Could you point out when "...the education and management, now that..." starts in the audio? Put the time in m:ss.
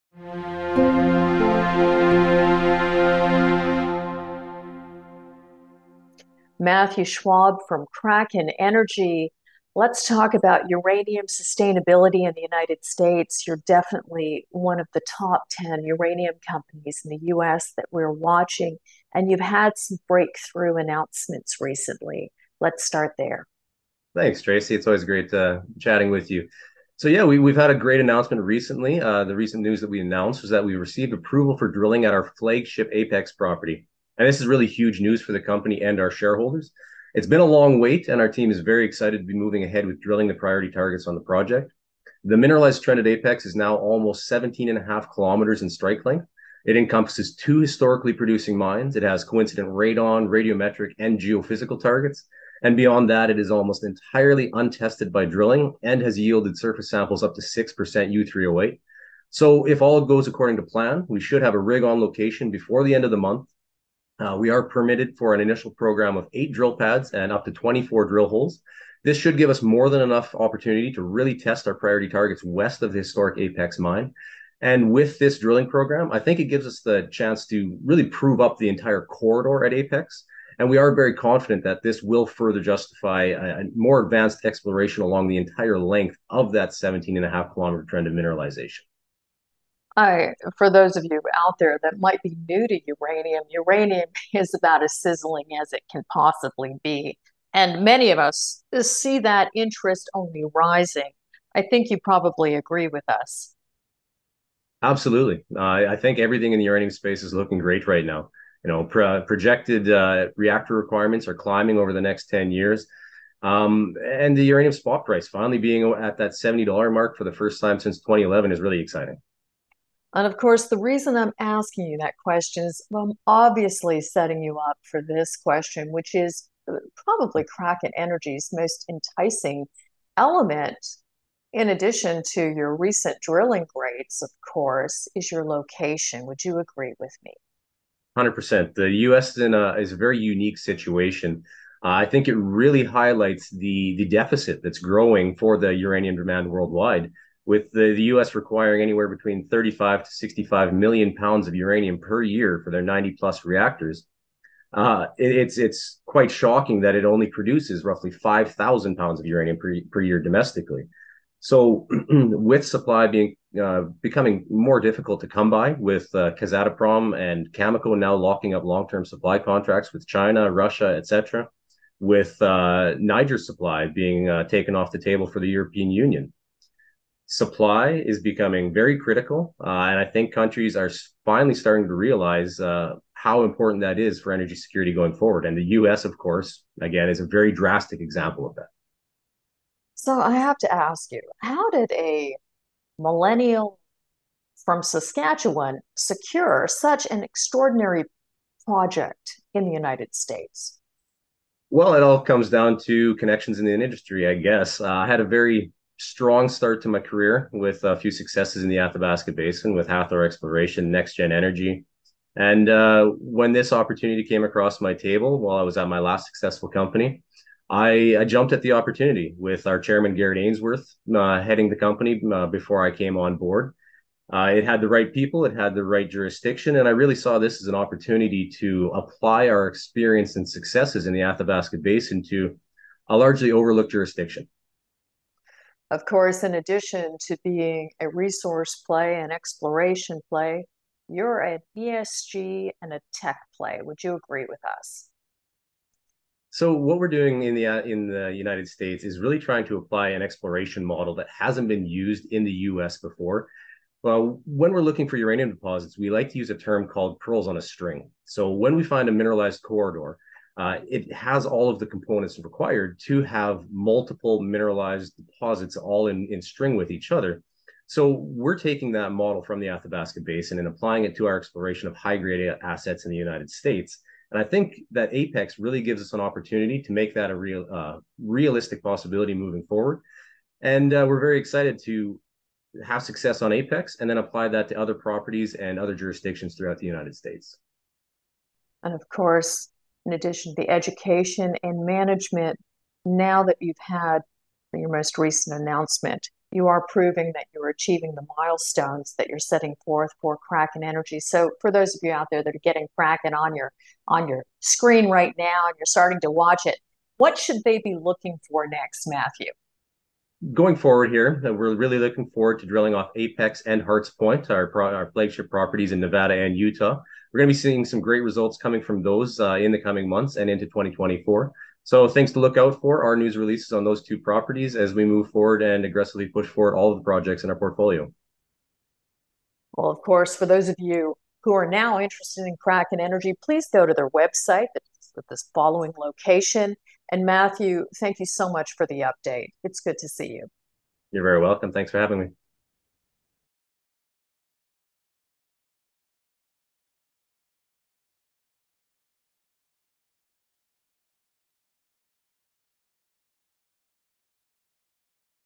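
4:50.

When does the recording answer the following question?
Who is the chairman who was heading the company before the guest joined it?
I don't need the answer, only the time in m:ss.
3:40.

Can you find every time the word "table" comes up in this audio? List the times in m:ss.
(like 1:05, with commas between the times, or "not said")
2:54, 3:34.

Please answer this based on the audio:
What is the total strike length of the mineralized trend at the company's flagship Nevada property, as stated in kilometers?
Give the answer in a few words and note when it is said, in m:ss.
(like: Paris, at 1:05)
17.5 kilometers, at 0:44.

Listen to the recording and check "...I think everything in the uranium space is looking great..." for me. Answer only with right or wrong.
right.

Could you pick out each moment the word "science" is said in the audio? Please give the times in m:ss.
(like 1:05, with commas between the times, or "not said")
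not said.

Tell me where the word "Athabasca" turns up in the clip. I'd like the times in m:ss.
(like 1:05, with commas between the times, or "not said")
3:28, 3:51, 4:29.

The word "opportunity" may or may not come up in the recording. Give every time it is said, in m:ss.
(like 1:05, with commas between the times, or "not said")
1:10, 3:33, 3:38, 3:47, 4:36.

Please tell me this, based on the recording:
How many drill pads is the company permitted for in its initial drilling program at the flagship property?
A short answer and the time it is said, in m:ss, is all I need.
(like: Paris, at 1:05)
8, at 1:06.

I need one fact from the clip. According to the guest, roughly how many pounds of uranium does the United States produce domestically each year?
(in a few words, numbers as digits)
5,000 pounds.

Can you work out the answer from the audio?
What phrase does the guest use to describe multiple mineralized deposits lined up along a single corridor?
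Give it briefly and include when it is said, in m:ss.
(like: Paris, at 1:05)
pearls on a string, at 4:17.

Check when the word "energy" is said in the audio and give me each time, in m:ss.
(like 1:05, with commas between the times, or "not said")
0:08, 2:07, 3:04, 3:31, 5:00, 5:32.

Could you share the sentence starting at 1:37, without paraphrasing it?
And many of us see that interest only rising.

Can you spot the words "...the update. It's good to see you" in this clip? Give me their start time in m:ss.
5:38.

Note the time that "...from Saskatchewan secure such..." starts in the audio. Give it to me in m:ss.
3:14.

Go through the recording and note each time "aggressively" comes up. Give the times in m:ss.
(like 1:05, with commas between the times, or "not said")
5:25.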